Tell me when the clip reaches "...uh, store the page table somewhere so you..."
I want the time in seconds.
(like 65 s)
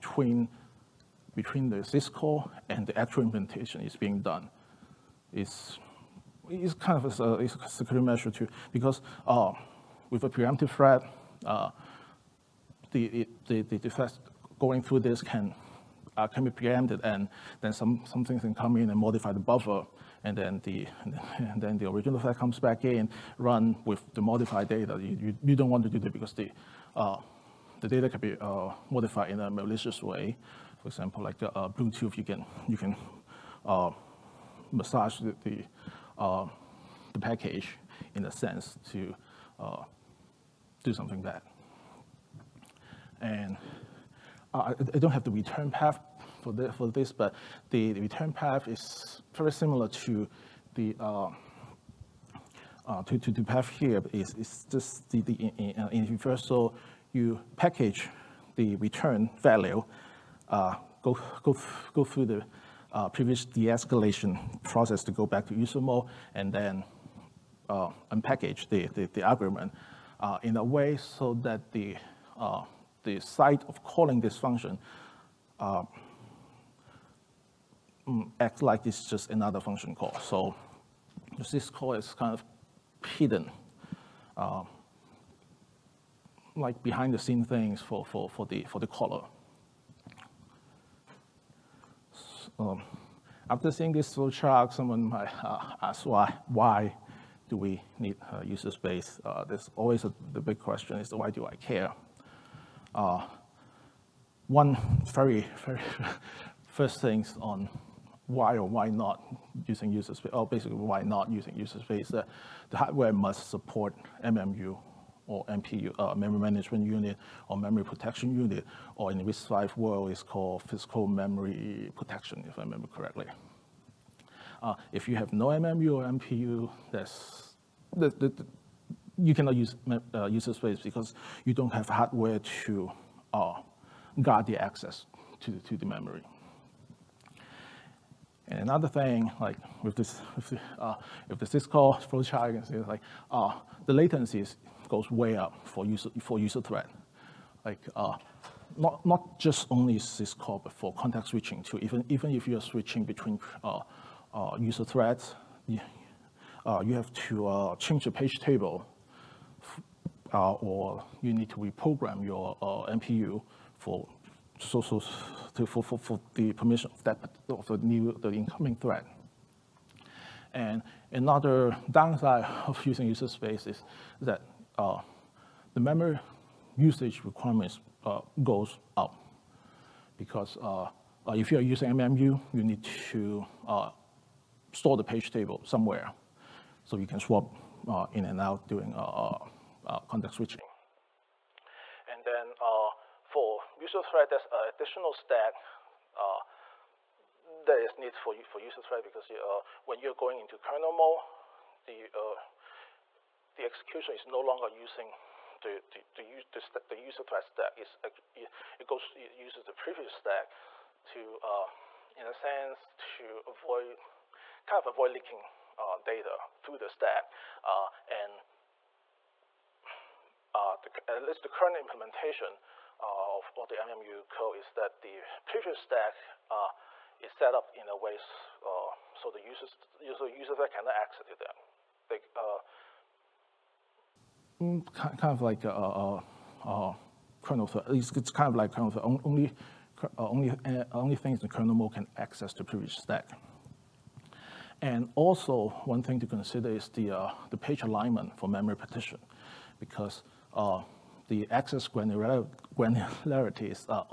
183 s.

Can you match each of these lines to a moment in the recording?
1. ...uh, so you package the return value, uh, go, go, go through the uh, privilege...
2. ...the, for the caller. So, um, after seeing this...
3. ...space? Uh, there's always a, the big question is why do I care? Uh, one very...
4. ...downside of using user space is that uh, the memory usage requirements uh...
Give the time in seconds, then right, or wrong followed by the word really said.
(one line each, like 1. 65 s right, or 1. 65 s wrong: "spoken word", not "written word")
1. 56 s right
2. 88 s right
3. 98 s right
4. 171 s right.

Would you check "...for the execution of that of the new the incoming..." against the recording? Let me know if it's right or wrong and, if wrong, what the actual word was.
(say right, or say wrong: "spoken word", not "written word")
wrong: "permission", not "execution".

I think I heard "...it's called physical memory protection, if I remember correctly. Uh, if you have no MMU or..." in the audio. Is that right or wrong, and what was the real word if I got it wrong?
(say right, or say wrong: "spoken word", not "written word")
right.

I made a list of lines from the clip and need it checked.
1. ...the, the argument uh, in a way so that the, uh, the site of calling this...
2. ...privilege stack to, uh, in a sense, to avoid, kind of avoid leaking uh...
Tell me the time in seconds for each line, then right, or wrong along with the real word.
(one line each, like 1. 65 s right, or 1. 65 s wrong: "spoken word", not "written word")
1. 68 s right
2. 209 s right.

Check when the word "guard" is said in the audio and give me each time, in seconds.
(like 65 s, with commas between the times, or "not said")
134 s.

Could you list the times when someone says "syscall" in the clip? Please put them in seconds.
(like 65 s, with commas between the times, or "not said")
1 s, 141 s, 149 s.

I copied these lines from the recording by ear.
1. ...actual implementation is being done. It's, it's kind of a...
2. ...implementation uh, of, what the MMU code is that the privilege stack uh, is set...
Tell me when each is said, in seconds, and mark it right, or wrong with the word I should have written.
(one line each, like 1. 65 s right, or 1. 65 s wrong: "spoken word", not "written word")
1. 2 s right
2. 221 s right.